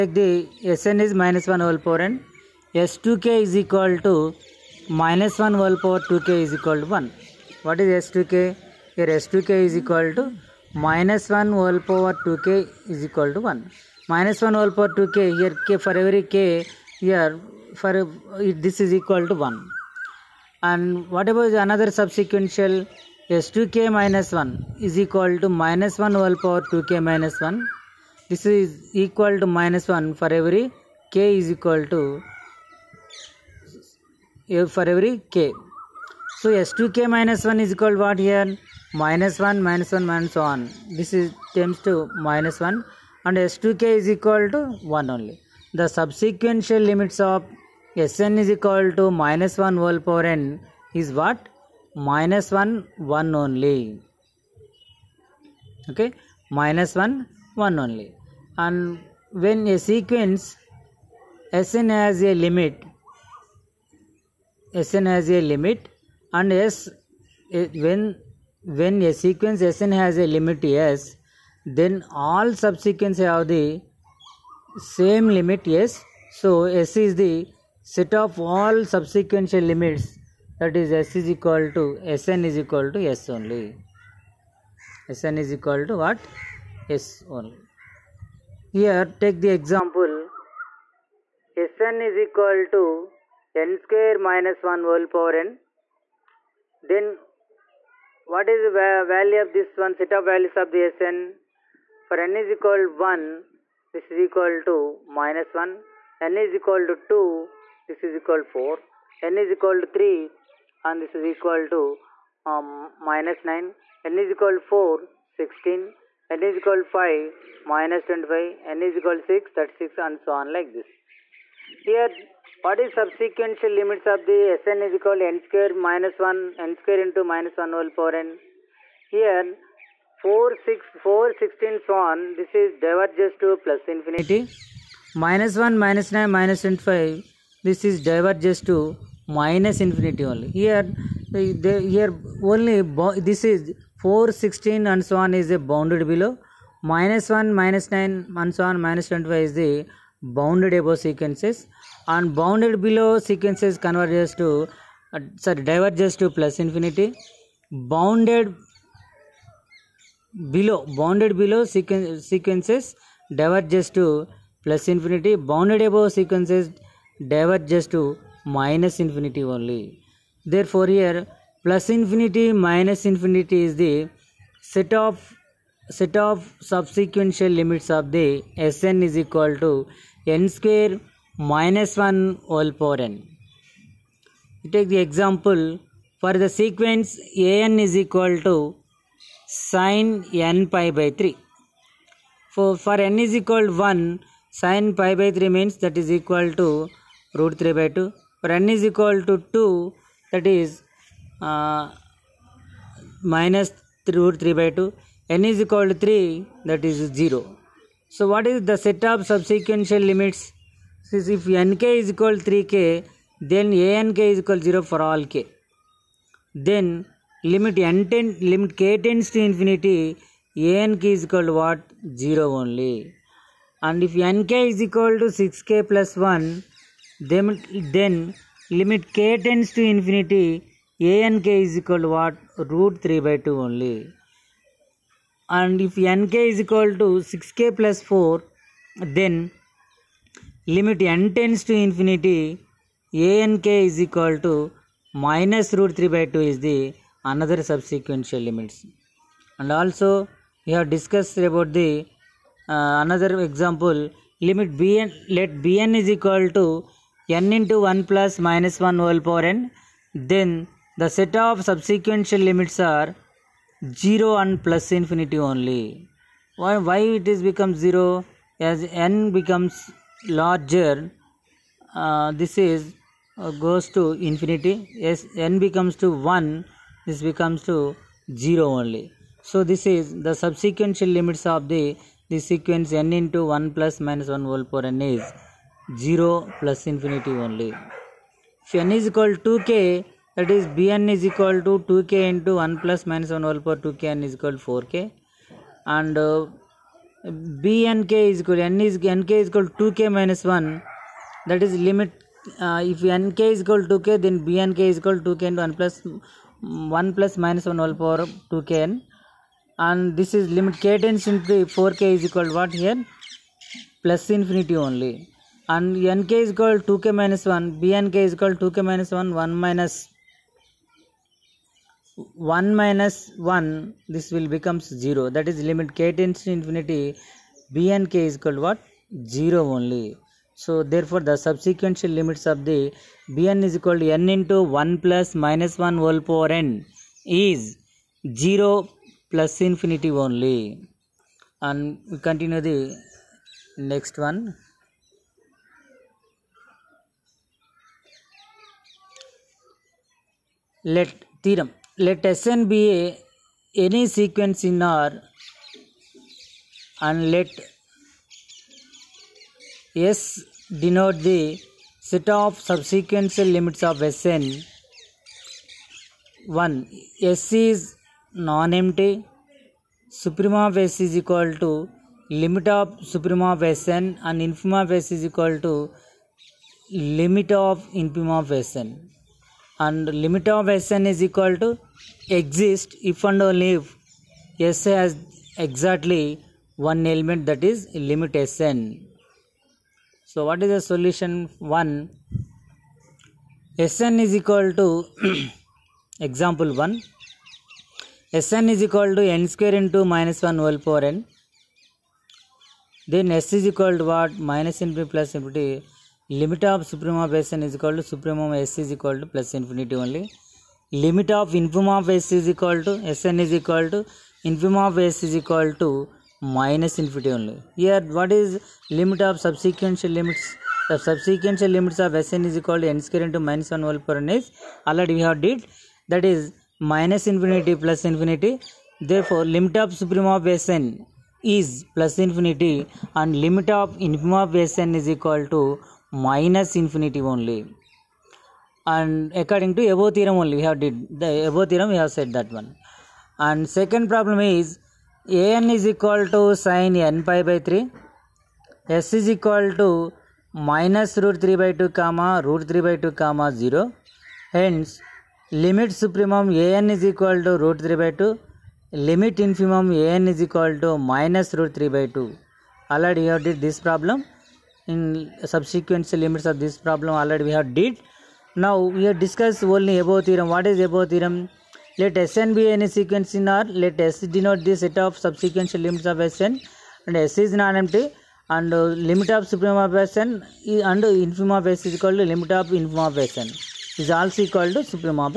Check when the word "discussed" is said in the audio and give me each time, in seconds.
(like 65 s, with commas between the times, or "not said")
250 s, 469 s.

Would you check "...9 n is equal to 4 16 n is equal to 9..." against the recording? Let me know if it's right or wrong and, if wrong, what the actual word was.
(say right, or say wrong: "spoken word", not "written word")
wrong: "5", not "9".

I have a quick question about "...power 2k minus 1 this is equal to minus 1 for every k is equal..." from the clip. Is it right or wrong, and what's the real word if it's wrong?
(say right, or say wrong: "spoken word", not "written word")
right.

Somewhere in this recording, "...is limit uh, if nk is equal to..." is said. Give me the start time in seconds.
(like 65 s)
301 s.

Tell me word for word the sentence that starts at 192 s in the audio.
For, for n is equal to 1, sine pi by 3 means that is equal to root 3 by 2.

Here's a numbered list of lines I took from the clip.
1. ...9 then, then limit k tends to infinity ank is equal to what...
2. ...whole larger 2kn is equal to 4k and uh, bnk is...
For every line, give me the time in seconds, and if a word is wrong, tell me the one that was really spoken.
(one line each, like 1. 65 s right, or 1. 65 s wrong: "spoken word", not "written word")
1. 226 s wrong: "1", not "9"
2. 293 s wrong: "power", not "larger".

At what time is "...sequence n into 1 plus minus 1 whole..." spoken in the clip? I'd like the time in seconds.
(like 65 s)
282 s.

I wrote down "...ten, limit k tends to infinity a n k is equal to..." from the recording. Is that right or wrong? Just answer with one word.
right.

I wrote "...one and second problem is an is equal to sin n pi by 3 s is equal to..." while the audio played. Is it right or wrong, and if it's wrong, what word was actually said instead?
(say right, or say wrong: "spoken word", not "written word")
right.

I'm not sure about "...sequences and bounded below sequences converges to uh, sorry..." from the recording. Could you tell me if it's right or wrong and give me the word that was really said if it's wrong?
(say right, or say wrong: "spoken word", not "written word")
right.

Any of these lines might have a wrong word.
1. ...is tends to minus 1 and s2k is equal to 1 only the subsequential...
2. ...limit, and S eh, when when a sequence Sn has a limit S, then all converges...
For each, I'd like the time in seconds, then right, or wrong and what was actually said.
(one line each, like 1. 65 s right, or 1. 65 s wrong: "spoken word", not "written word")
1. 41 s right
2. 65 s wrong: "subsequences", not "converges".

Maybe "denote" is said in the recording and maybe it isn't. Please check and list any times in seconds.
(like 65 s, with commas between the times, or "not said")
360 s, 474 s.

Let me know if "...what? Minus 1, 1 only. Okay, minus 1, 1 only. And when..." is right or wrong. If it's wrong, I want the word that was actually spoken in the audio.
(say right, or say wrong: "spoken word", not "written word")
right.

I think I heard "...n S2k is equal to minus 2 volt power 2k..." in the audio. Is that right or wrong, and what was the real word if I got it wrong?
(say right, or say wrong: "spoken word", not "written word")
wrong: "1", not "2".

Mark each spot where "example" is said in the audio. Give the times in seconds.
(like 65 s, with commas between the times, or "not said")
89 s, 184 s, 253 s, 396 s.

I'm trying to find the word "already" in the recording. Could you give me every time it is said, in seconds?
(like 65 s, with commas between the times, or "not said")
424 s, 462 s, 467 s.